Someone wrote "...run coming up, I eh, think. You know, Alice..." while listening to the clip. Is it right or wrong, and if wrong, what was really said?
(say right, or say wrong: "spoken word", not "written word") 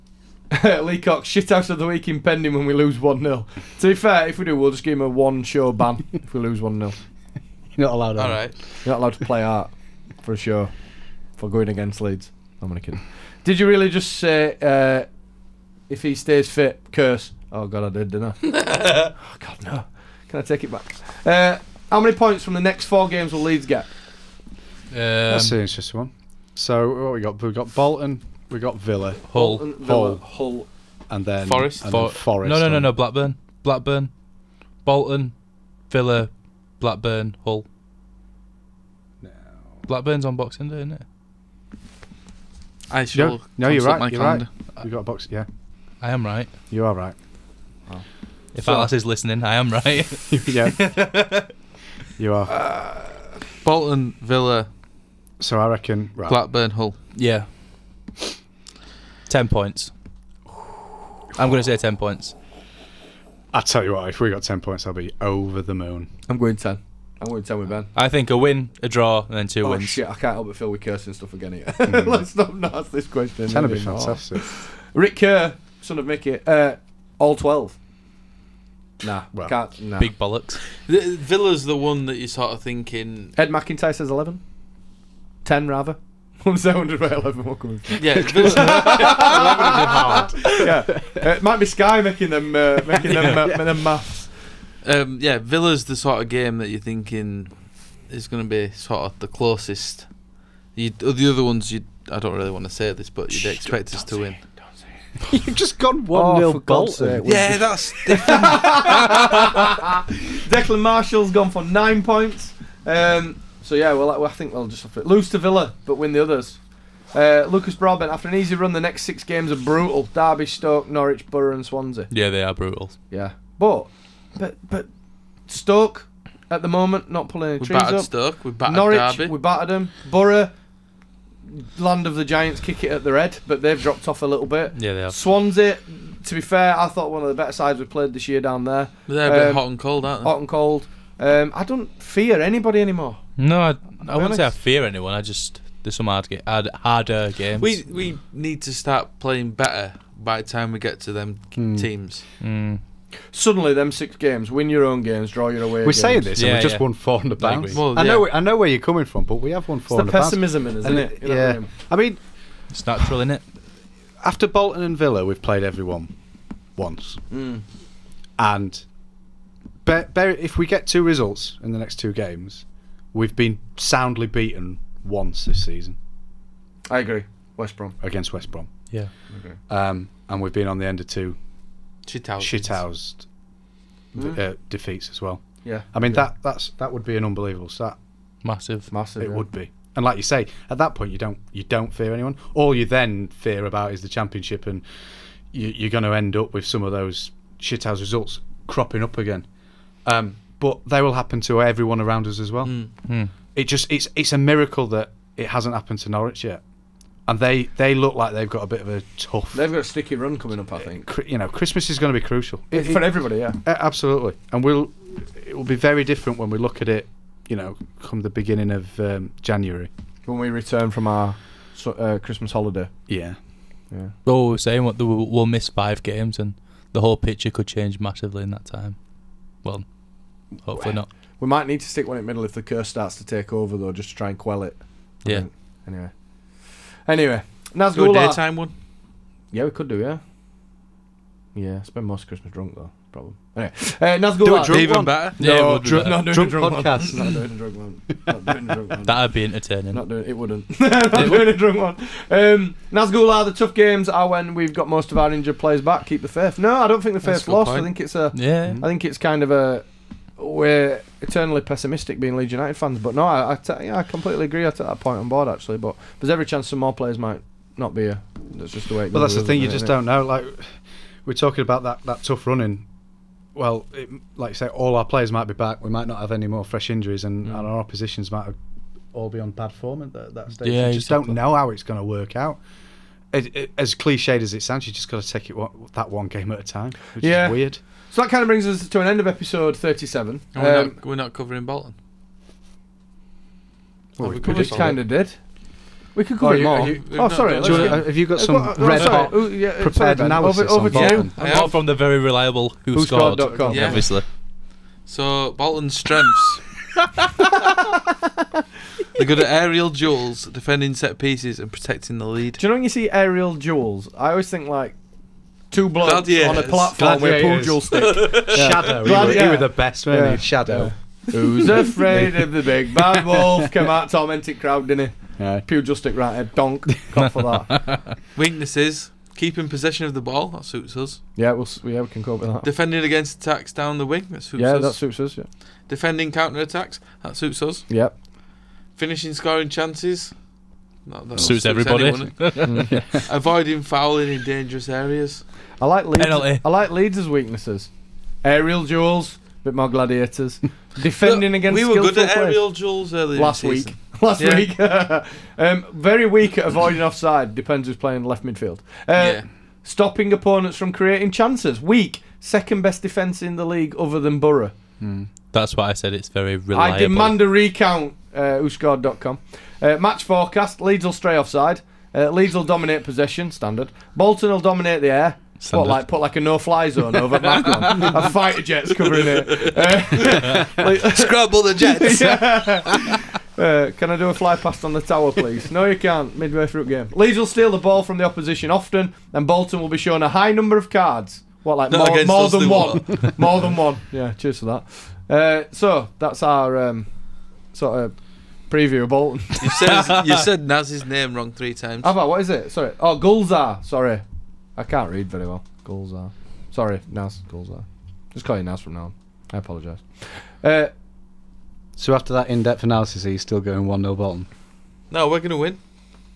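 wrong: "Christmas", not "Alice".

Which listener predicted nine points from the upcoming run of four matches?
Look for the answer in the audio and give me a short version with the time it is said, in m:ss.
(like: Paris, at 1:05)
Declan Marshall, at 1:50.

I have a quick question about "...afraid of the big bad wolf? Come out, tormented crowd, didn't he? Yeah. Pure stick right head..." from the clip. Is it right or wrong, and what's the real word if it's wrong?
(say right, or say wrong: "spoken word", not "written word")
right.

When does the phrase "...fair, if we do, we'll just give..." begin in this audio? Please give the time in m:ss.
0:03.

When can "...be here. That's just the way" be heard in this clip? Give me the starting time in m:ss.
4:27.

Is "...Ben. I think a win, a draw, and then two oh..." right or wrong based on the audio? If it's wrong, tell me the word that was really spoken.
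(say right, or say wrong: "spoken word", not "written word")
right.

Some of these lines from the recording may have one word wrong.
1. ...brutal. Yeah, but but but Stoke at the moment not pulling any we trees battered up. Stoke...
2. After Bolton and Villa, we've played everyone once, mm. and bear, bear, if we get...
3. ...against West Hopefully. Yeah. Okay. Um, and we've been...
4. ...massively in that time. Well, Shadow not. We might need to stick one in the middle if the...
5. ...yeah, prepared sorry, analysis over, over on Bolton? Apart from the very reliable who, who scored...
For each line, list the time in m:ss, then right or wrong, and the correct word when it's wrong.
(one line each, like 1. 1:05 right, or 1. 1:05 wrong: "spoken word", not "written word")
1. 2:02 right
2. 2:44 right
3. 2:58 wrong: "Brom", not "Hopefully"
4. 3:47 wrong: "Hopefully", not "Shadow"
5. 4:59 right.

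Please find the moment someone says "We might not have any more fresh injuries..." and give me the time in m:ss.
4:35.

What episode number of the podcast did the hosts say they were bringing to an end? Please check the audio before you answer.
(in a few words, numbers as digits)
37.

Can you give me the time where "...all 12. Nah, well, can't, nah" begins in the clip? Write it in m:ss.
1:17.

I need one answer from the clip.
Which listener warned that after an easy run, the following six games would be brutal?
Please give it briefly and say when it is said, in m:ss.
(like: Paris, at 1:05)
Lucas Broadbent, at 1:57.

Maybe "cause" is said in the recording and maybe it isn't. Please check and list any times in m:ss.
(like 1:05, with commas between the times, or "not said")
not said.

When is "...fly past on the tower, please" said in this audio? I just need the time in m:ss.
6:24.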